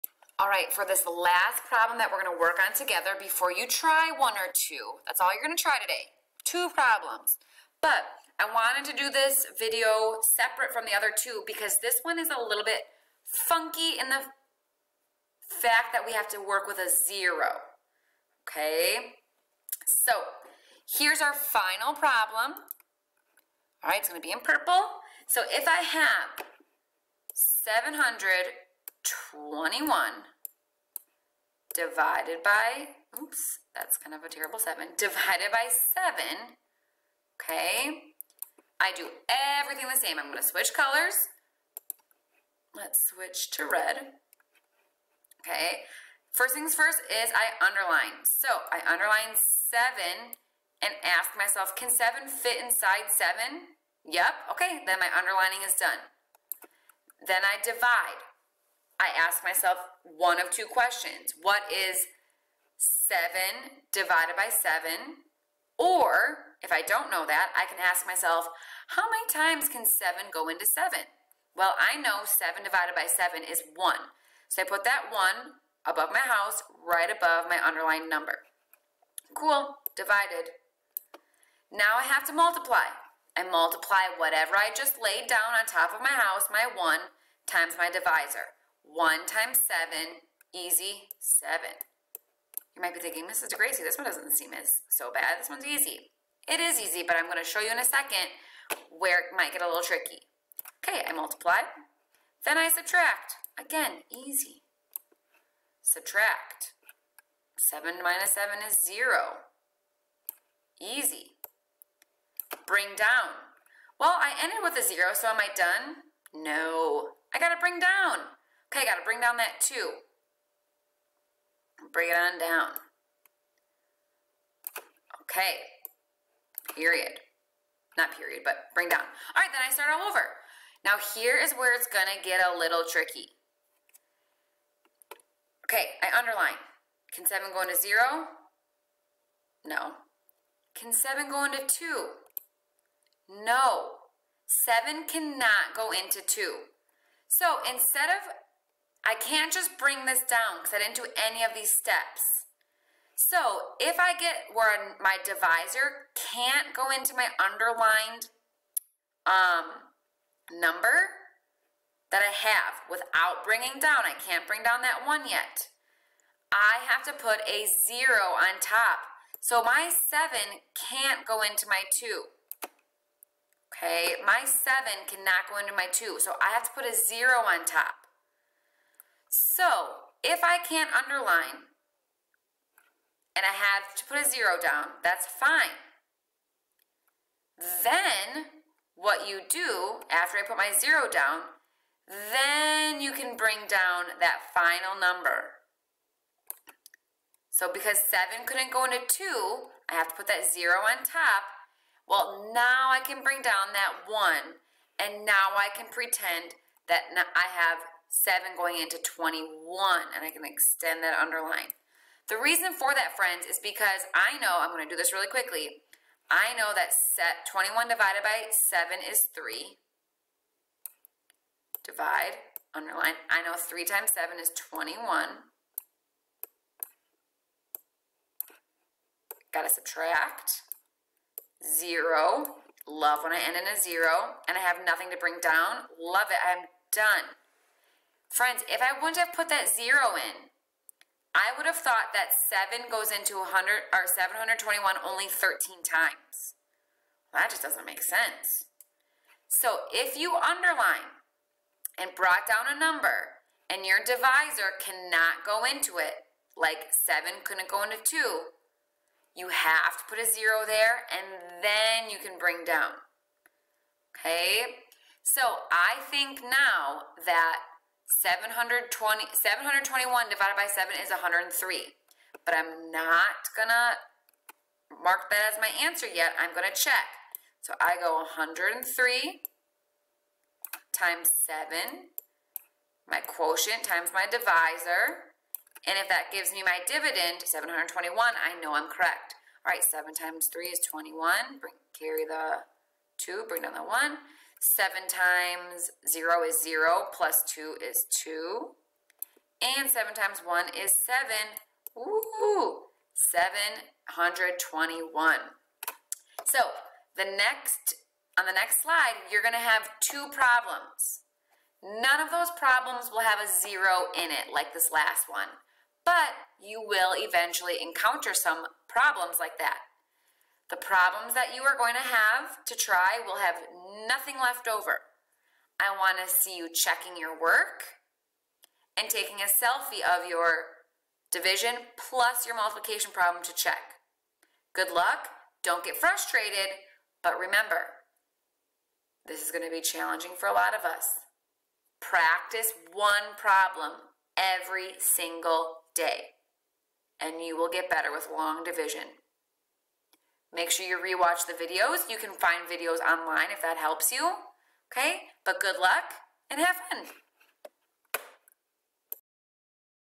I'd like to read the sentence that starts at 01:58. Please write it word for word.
Okay, got to bring down that 2.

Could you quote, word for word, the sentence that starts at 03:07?
Then what you do after I put my zero down, then you can bring down that final number.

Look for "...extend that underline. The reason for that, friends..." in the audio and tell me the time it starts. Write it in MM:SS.
03:30.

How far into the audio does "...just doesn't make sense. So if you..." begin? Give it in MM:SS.
04:07.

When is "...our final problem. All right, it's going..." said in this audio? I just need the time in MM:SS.
00:21.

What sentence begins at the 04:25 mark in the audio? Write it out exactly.
So I think now that 720, 721 divided by 7 is 103.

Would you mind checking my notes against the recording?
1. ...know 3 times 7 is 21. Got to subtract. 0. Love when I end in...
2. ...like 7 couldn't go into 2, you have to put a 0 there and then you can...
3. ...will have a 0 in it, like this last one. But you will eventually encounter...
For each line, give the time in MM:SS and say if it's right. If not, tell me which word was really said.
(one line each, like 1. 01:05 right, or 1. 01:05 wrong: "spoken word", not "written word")
1. 03:43 right
2. 04:16 right
3. 05:13 right.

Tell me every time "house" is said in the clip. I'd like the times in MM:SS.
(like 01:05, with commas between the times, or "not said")
01:16, 01:26.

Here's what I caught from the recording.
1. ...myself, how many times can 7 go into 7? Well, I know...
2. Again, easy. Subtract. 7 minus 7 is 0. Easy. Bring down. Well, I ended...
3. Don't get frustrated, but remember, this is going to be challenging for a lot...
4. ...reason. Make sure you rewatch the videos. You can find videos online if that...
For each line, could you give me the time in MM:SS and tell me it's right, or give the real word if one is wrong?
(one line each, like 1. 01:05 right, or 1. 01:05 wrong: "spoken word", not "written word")
1. 01:08 right
2. 01:43 right
3. 05:35 right
4. 05:48 wrong: "division", not "reason".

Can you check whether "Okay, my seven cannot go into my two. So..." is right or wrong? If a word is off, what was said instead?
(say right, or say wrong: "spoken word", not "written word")
right.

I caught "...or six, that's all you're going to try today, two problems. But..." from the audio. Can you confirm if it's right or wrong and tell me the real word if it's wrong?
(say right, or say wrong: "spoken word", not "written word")
wrong: "two", not "six".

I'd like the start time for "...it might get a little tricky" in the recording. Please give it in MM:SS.
01:39.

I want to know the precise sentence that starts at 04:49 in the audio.
All right, 7 times 3 is 21.